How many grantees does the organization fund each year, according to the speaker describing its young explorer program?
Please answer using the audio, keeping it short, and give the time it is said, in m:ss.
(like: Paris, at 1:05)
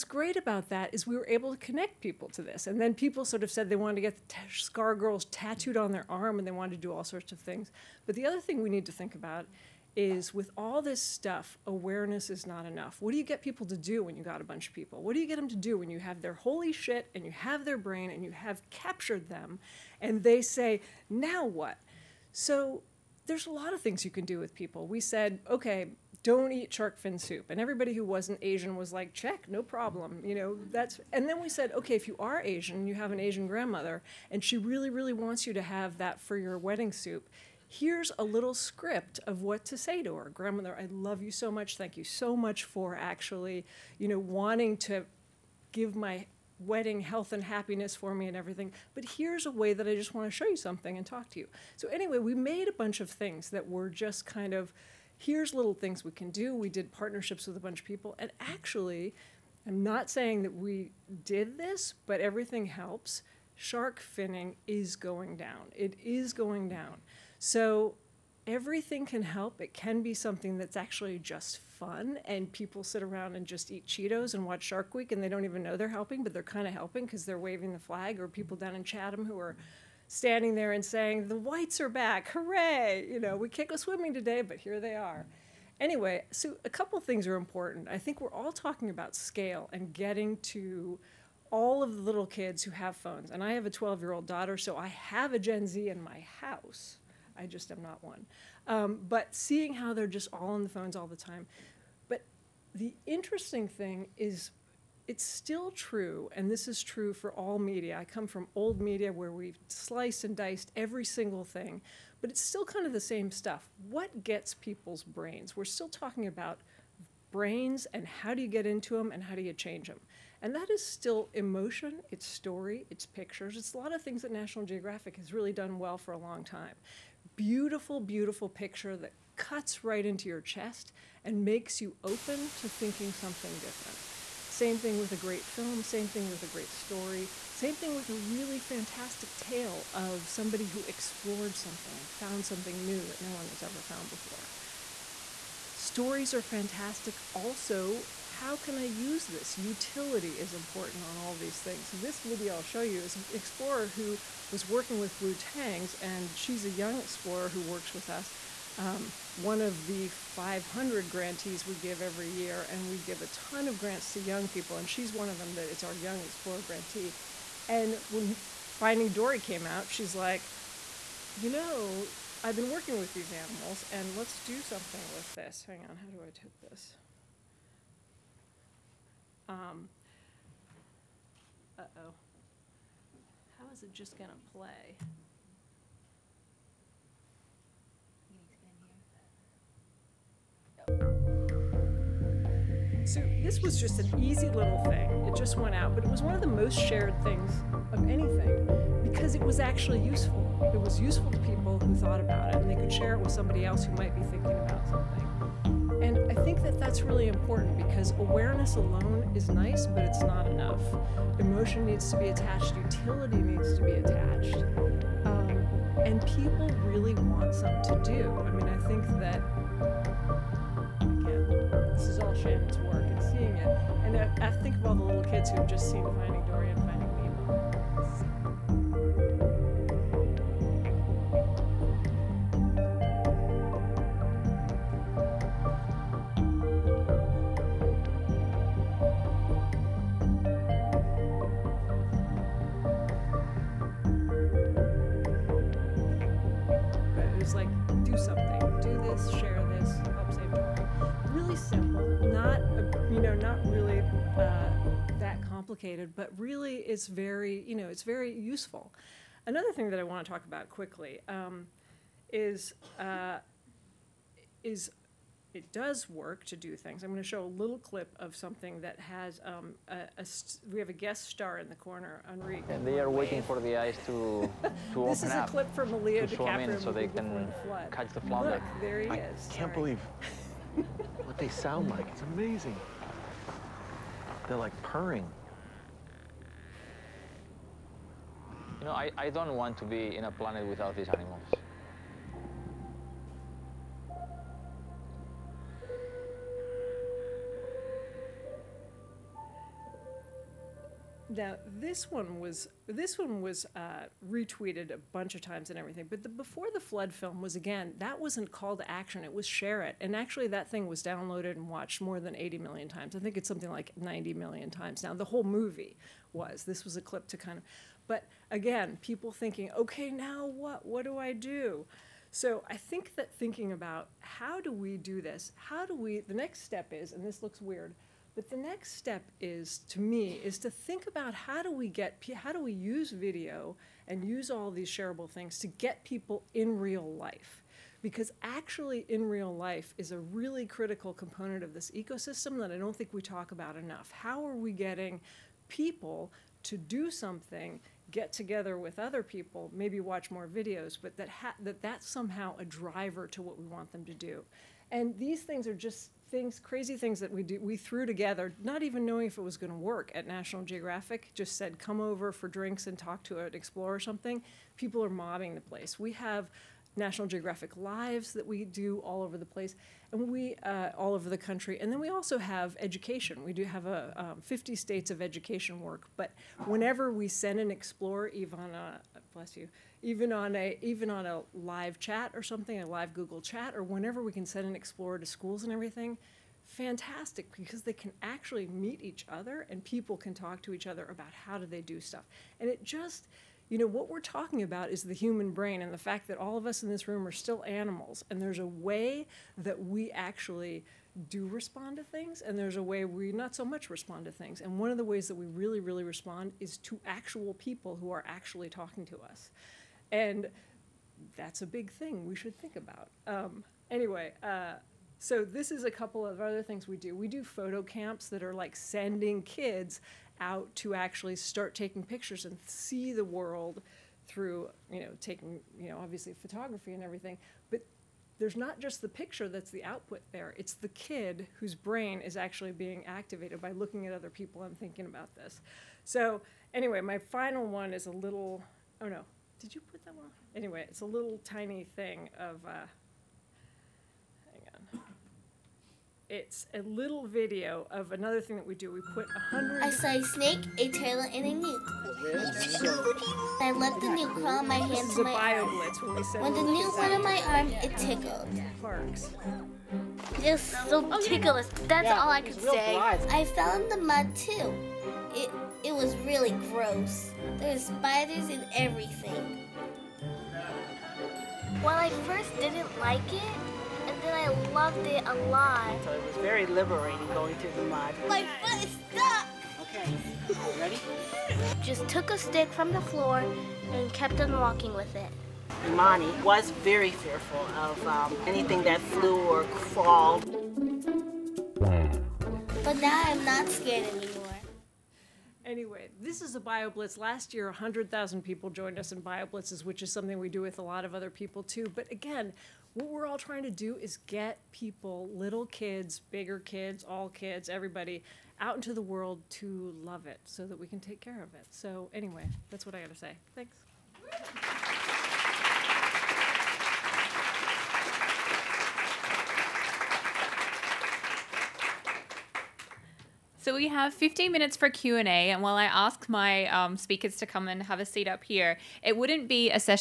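500, at 2:40.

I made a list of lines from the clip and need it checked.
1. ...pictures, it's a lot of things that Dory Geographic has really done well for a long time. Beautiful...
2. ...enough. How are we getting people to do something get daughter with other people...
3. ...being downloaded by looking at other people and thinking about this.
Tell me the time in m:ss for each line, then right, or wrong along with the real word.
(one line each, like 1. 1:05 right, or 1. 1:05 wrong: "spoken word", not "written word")
1. 2:03 wrong: "National", not "Dory"
2. 5:43 wrong: "together", not "daughter"
3. 7:12 wrong: "activated", not "downloaded".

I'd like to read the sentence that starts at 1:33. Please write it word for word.
And I have a 12 year old daughter, so I have a Gen Z in my house.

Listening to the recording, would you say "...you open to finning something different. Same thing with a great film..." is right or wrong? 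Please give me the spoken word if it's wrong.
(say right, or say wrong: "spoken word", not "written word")
wrong: "thinking", not "finning".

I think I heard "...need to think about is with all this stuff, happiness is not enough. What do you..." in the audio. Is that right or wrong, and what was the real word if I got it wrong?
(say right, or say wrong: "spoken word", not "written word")
wrong: "awareness", not "happiness".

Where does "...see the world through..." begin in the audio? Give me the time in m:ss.
7:02.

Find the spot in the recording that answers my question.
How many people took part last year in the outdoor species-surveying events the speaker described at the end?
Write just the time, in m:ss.
8:17.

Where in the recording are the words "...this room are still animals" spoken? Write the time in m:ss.
6:36.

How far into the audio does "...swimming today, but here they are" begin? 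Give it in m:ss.
1:23.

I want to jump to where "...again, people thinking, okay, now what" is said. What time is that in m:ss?
5:18.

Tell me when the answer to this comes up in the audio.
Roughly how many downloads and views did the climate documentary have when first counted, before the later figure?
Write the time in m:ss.
5:12.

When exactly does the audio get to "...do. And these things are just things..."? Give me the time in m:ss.
5:54.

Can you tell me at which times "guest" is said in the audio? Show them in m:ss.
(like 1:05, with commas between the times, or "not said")
4:31.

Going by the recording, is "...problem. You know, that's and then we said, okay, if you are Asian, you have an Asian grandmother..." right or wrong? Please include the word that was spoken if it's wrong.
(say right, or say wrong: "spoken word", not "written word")
right.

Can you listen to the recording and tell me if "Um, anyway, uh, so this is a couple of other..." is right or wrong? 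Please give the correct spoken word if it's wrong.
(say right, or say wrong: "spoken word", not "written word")
right.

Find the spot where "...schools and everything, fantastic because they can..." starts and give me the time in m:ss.
6:25.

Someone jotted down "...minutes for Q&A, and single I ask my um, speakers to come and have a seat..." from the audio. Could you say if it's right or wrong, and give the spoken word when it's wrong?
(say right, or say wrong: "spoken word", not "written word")
wrong: "while", not "single".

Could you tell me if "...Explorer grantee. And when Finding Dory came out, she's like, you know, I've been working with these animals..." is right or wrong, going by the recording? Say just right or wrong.
right.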